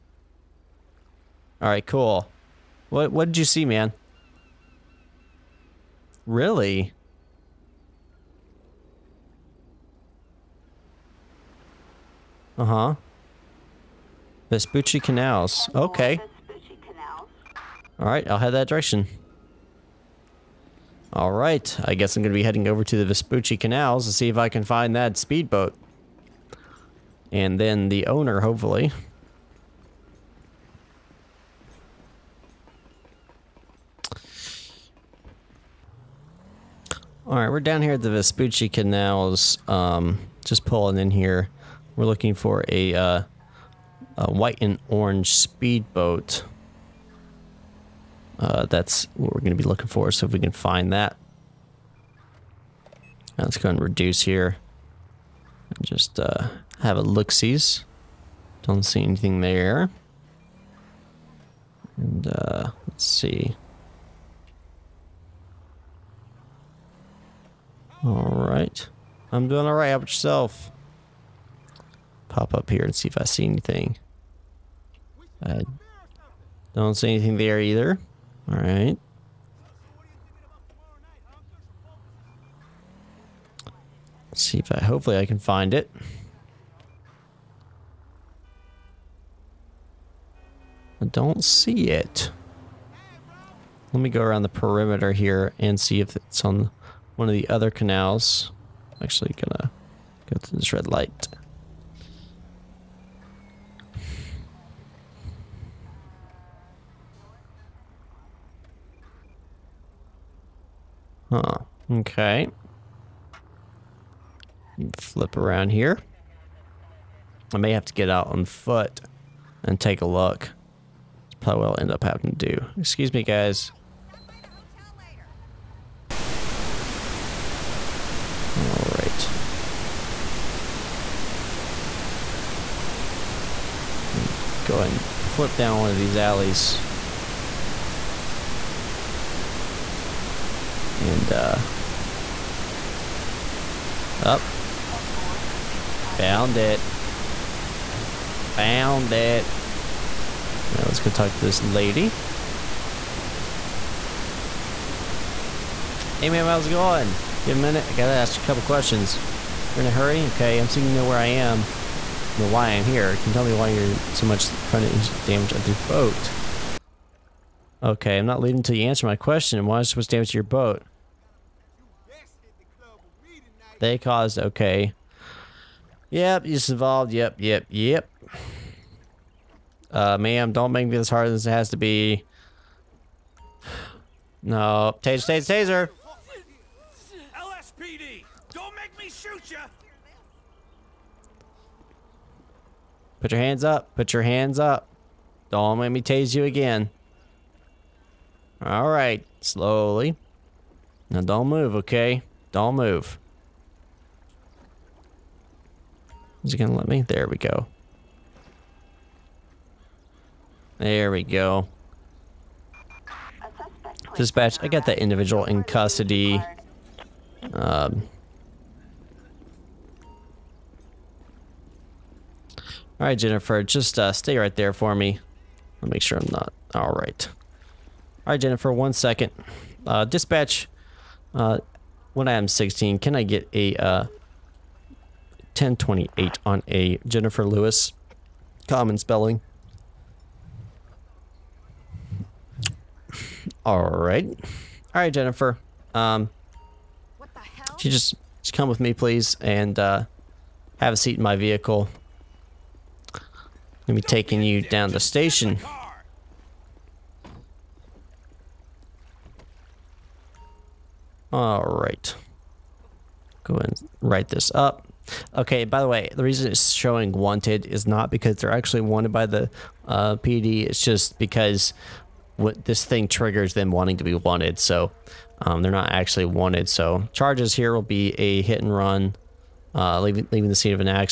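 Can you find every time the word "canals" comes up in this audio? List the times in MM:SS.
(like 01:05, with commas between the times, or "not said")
00:14, 00:23, 00:38, 01:37.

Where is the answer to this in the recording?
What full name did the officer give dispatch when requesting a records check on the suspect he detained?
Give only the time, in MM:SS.
03:57.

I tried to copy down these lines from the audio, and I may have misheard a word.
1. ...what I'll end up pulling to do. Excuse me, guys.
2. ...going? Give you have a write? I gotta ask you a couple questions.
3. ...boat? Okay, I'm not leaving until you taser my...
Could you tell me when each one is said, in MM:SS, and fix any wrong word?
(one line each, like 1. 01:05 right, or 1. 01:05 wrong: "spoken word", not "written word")
1. 02:01 wrong: "having", not "pulling"
2. 02:36 wrong: "minute", not "write"
3. 02:45 wrong: "answer", not "taser".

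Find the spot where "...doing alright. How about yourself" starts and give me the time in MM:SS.
01:09.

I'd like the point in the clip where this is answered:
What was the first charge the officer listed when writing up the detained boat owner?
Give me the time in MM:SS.
04:38.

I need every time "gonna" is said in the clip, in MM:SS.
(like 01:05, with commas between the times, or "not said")
01:39, 03:26.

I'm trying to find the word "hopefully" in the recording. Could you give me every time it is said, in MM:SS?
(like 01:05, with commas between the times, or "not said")
00:28, 01:24.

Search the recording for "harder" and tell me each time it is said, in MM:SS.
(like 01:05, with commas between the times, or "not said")
03:01.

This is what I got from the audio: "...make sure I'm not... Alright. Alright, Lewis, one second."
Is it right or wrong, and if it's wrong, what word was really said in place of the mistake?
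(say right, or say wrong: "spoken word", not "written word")
wrong: "Jennifer", not "Lewis".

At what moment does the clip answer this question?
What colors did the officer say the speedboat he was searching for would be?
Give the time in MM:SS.
00:44.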